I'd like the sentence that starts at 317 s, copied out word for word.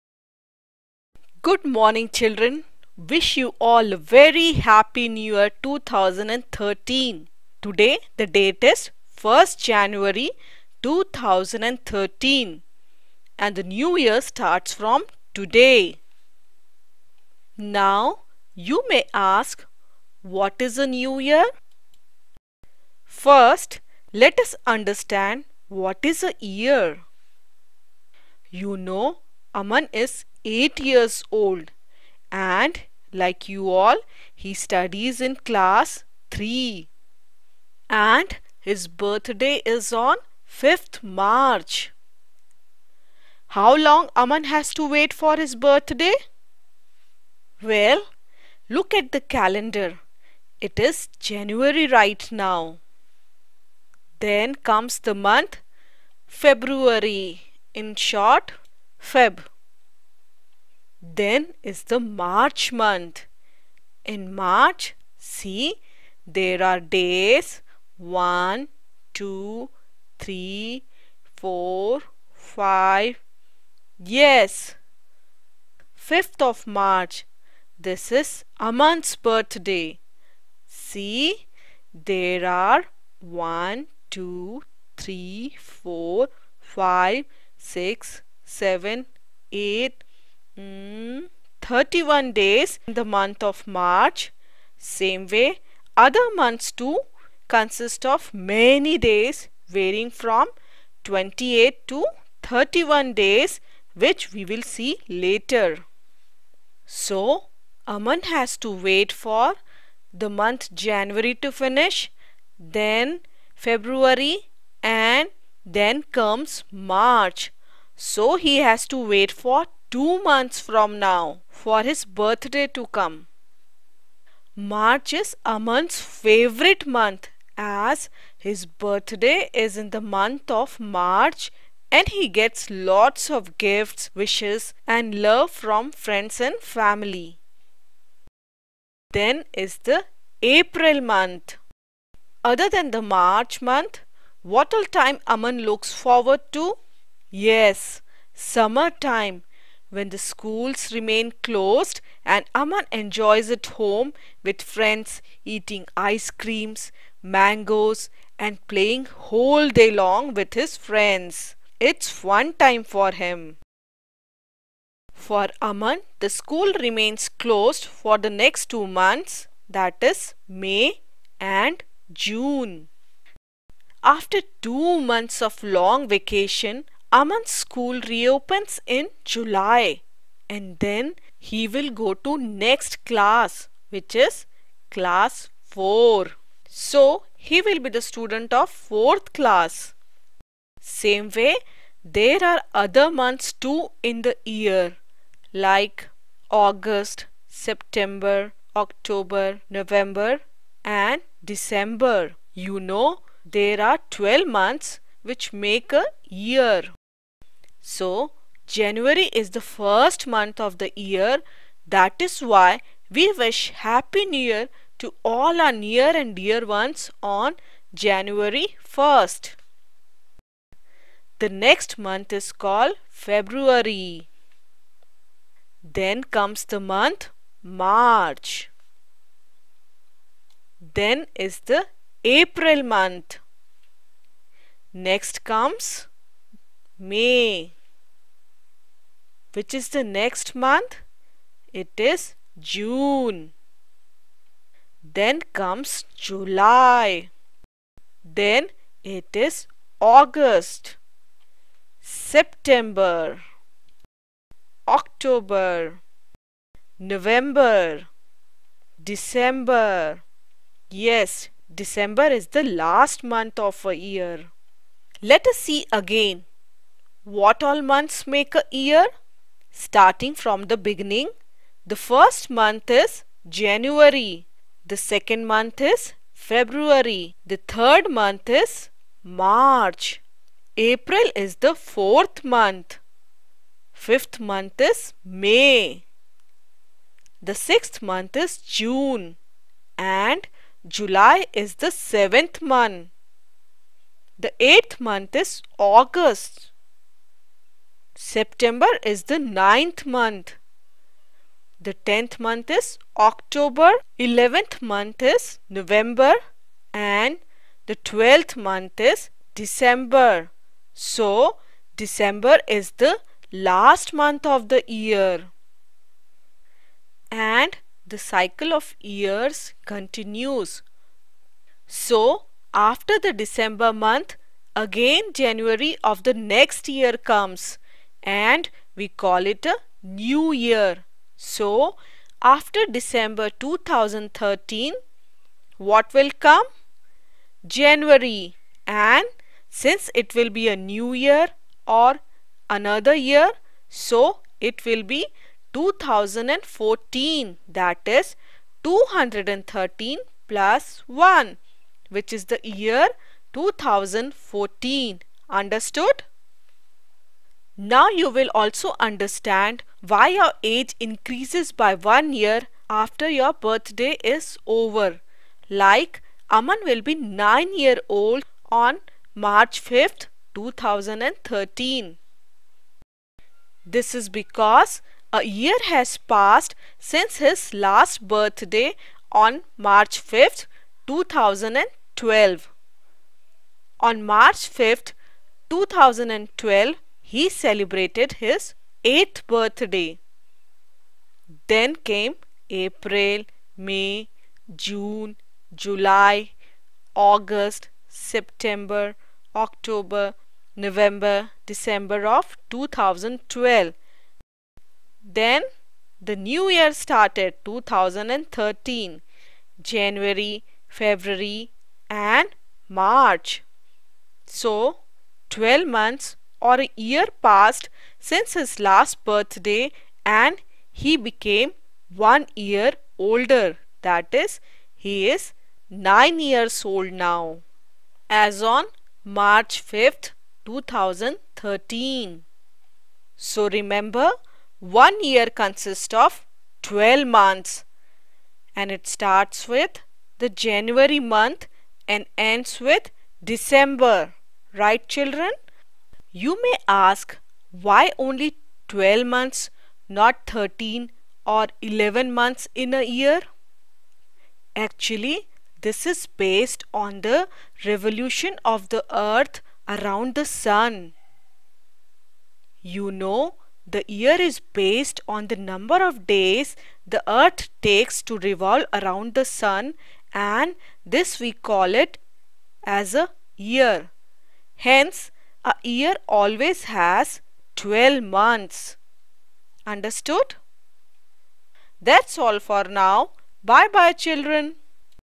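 And the cycle of years continues.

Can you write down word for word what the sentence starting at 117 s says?
So, he has to wait for two months from now for his birthday to come.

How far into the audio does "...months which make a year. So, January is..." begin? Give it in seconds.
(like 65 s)
204 s.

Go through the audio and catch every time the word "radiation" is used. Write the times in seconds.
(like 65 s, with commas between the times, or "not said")
not said.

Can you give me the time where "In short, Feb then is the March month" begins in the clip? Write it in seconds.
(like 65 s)
57 s.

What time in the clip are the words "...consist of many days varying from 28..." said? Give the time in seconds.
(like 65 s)
97 s.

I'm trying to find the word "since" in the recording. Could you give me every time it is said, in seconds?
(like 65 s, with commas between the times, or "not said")
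339 s, 376 s, 418 s.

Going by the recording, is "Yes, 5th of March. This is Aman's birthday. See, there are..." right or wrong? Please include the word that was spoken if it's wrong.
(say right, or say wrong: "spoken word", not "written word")
right.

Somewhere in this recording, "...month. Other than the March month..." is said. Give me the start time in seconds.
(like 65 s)
141 s.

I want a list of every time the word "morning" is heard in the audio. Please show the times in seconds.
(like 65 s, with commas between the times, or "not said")
1 s.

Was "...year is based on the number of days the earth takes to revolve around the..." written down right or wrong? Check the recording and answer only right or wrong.
right.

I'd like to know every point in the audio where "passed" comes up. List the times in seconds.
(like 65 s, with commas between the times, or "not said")
376 s, 417 s.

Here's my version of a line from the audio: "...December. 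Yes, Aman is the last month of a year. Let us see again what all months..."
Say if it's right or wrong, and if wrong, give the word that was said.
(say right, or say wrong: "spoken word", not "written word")
wrong: "December", not "Aman".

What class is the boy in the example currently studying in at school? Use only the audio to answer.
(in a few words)
class 3.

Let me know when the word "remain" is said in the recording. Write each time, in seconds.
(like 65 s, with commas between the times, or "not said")
150 s, 166 s.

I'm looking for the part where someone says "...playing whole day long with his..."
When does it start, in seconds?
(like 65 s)
158 s.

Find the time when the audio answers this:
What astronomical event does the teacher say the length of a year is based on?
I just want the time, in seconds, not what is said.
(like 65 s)
457 s.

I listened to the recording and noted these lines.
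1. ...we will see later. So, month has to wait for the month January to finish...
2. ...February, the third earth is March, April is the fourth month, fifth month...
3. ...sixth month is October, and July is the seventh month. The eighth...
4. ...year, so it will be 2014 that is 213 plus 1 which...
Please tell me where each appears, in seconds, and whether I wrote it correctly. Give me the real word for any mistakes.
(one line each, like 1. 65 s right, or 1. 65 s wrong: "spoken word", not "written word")
1. 104 s right
2. 276 s wrong: "month", not "earth"
3. 287 s wrong: "June", not "October"
4. 343 s right.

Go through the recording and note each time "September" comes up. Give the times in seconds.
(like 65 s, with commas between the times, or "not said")
197 s, 251 s, 298 s, 398 s.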